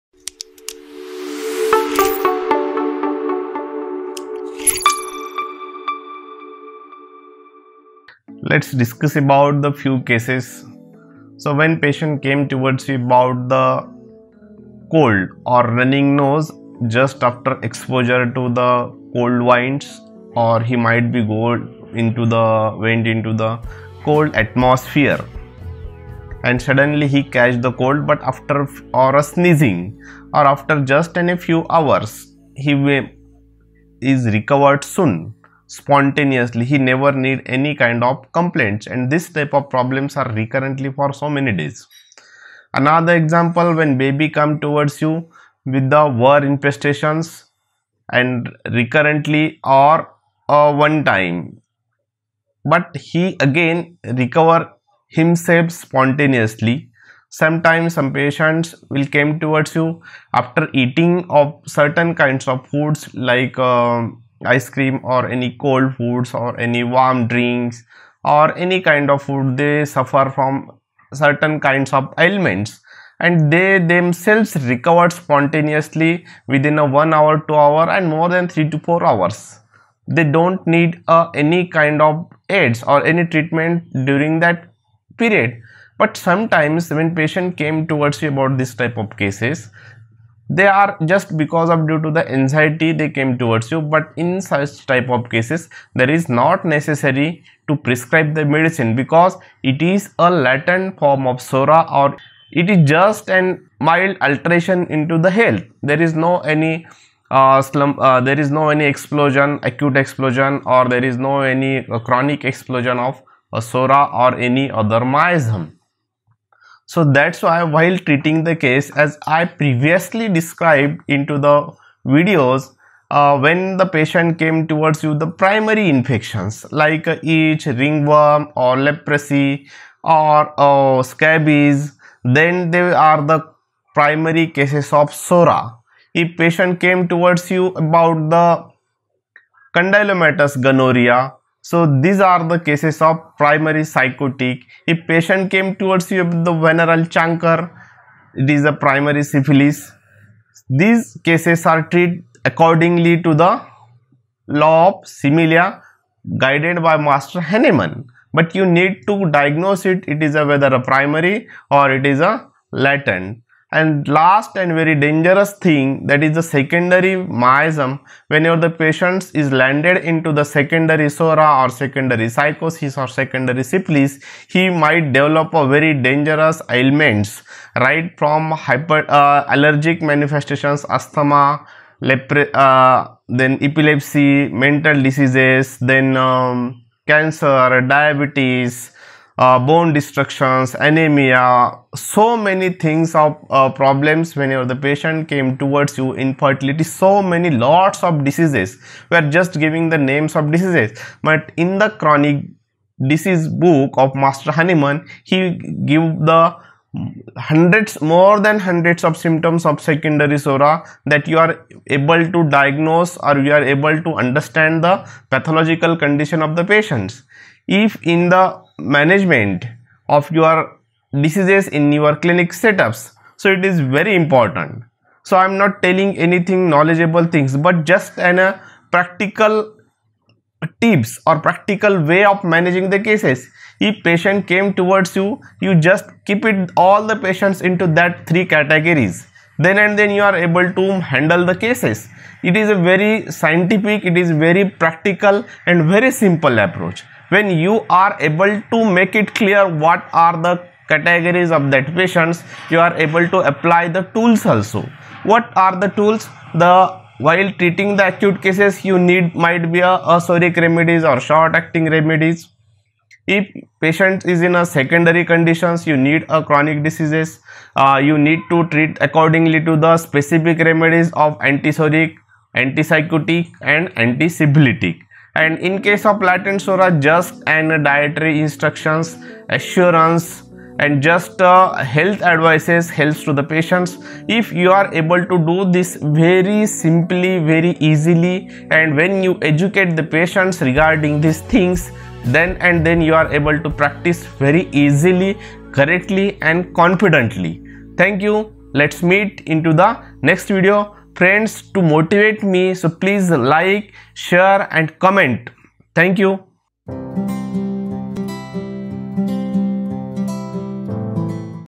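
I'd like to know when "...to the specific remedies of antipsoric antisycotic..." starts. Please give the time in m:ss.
4:29.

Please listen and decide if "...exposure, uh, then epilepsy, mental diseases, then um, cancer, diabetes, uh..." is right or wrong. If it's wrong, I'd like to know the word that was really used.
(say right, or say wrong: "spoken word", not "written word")
wrong: "lepre", not "exposure".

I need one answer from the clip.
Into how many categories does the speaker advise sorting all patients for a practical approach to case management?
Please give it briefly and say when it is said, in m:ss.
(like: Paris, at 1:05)
3, at 3:58.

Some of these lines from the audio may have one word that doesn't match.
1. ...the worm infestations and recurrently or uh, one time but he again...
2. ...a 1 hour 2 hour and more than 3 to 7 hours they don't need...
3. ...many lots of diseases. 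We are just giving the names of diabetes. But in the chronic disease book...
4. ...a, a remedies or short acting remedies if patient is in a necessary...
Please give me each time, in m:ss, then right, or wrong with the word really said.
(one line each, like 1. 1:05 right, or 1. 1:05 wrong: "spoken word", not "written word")
1. 0:45 right
2. 1:16 wrong: "4", not "7"
3. 3:17 wrong: "diseases", not "diabetes"
4. 4:19 wrong: "secondary", not "necessary".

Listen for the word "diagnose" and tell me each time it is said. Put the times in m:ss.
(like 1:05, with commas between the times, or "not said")
2:39, 3:32.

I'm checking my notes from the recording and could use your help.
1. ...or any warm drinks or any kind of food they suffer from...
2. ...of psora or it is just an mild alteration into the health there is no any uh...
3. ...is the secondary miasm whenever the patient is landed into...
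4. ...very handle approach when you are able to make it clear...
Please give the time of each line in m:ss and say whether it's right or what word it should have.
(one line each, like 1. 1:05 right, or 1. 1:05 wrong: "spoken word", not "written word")
1. 1:06 right
2. 1:41 right
3. 2:46 right
4. 4:05 wrong: "simple", not "handle".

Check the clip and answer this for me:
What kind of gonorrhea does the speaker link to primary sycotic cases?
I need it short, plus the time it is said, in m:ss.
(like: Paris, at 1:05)
Condylomatous, at 2:19.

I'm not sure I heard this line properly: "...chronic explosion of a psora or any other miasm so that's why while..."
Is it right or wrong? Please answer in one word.
right.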